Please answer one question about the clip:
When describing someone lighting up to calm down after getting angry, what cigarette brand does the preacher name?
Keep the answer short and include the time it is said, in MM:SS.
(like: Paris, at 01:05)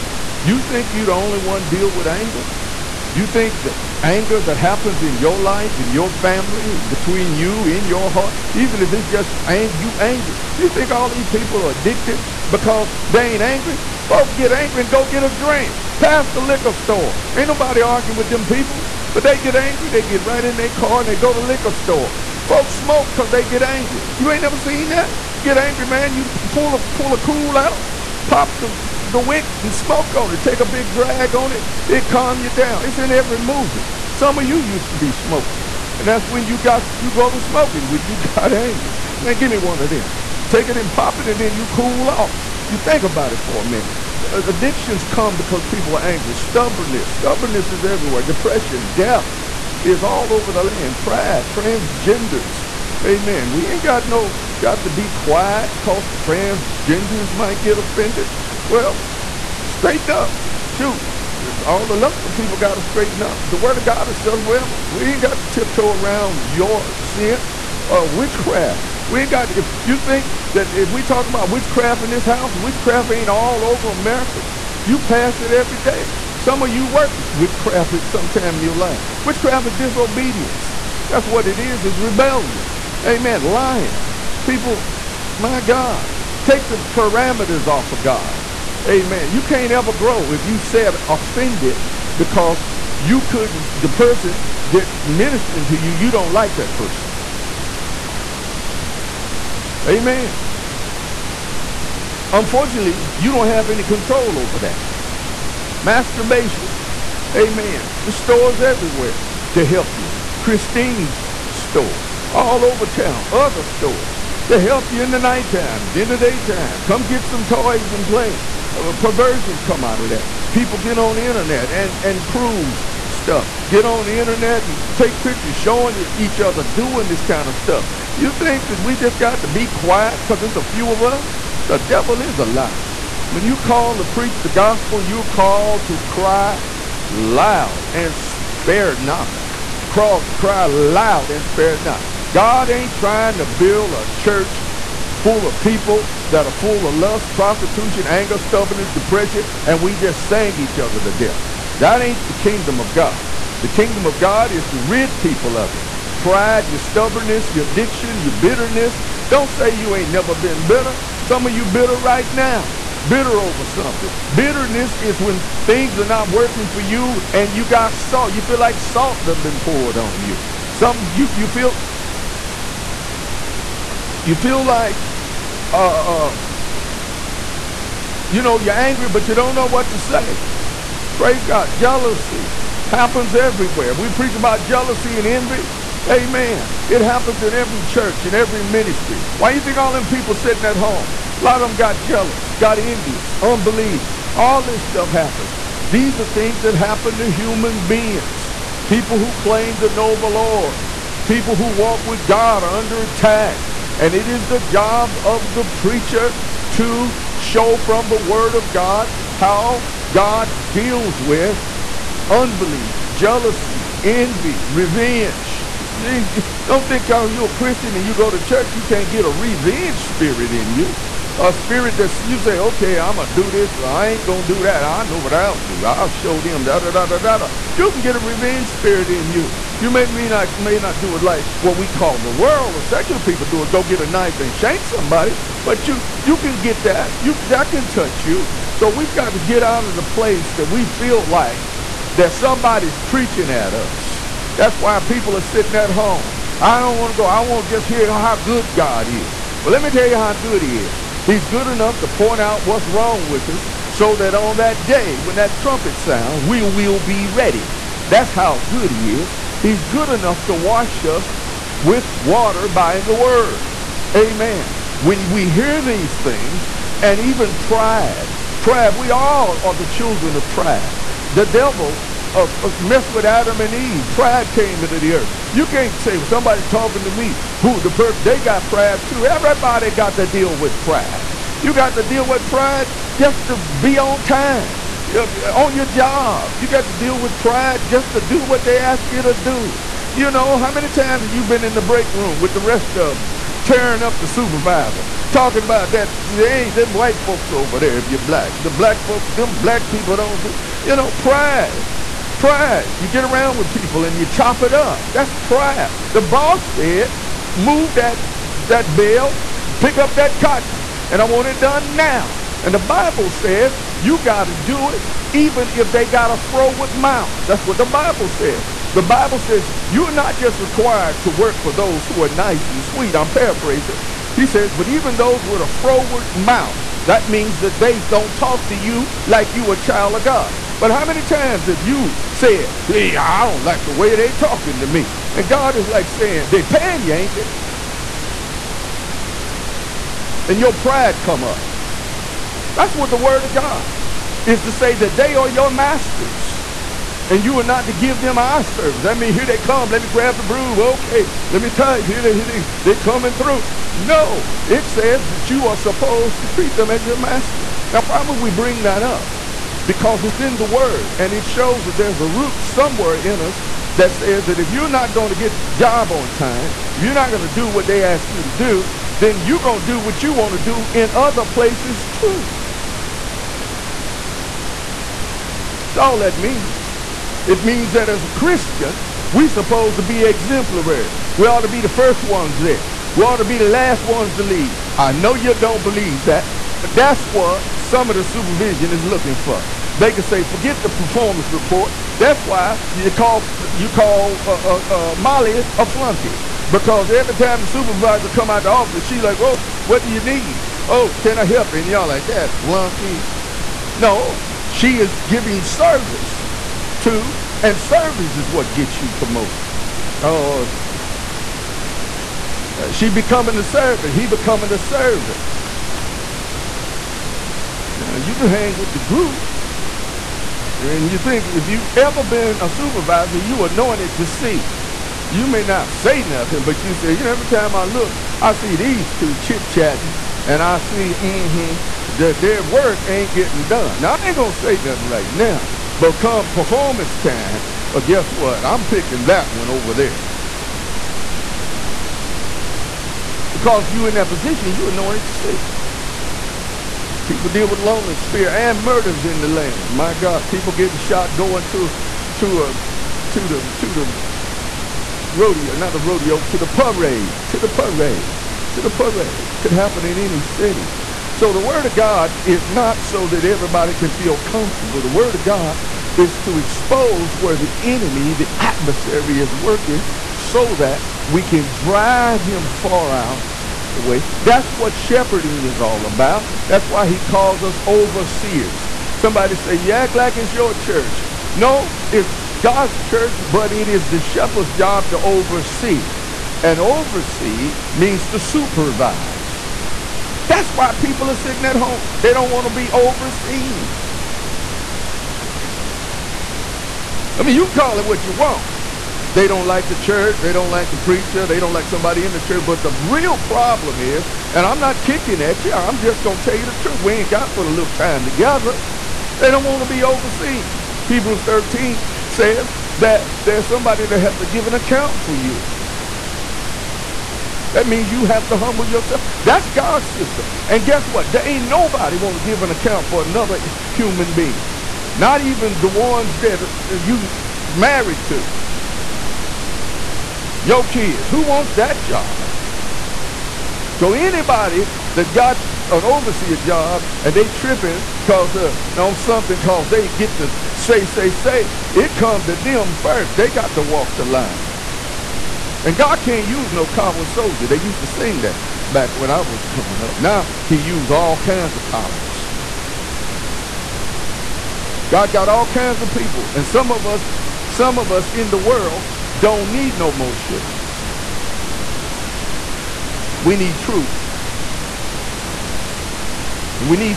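Kool, at 00:27.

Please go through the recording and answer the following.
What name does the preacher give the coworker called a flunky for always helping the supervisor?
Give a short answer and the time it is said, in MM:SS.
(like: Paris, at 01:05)
Molly, at 06:35.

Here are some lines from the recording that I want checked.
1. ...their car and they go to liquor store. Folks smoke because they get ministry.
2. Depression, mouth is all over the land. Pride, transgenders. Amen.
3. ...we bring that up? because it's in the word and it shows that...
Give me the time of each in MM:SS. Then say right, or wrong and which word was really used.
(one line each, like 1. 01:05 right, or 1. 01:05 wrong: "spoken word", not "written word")
1. 00:20 wrong: "angry", not "ministry"
2. 00:48 wrong: "death", not "mouth"
3. 05:58 right.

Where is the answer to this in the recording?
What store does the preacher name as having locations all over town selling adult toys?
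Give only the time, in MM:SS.
01:50.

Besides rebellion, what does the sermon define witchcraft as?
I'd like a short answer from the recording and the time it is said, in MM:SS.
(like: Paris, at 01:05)
Disobedience, at 01:19.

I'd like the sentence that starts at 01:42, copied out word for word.
Unfortunately, you don't have any control over that.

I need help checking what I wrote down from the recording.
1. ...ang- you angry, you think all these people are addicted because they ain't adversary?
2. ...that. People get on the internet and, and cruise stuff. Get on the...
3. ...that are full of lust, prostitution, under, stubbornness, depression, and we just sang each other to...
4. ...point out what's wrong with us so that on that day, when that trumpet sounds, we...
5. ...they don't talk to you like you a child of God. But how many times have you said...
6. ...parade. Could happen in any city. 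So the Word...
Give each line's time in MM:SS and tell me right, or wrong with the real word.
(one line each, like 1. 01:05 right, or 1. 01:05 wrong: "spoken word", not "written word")
1. 00:09 wrong: "angry", not "adversary"
2. 02:00 right
3. 02:26 wrong: "anger", not "under"
4. 04:12 right
5. 05:27 right
6. 07:38 right.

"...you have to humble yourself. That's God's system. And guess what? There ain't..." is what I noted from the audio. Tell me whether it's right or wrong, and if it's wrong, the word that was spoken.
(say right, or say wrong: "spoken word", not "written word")
right.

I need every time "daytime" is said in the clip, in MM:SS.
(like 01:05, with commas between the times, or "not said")
01:56.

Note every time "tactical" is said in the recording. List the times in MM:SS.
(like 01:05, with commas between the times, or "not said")
not said.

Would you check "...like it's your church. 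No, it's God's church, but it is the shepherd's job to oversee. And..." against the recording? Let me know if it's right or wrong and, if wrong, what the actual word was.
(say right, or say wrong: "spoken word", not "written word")
right.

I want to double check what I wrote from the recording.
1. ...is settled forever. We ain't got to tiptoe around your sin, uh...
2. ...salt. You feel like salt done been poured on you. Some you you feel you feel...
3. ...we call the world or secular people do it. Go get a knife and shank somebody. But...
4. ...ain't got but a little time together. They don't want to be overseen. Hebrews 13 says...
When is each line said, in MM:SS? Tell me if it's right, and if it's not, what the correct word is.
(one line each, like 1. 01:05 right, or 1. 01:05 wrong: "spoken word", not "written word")
1. 01:04 right
2. 02:47 right
3. 03:51 right
4. 08:27 right.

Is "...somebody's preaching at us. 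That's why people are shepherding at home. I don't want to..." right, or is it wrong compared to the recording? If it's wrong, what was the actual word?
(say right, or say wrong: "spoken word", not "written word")
wrong: "sitting", not "shepherding".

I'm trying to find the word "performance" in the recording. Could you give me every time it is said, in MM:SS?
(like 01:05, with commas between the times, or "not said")
06:30, 07:16.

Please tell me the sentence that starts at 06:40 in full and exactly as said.
Oh, can I help And y'all like that, flunky.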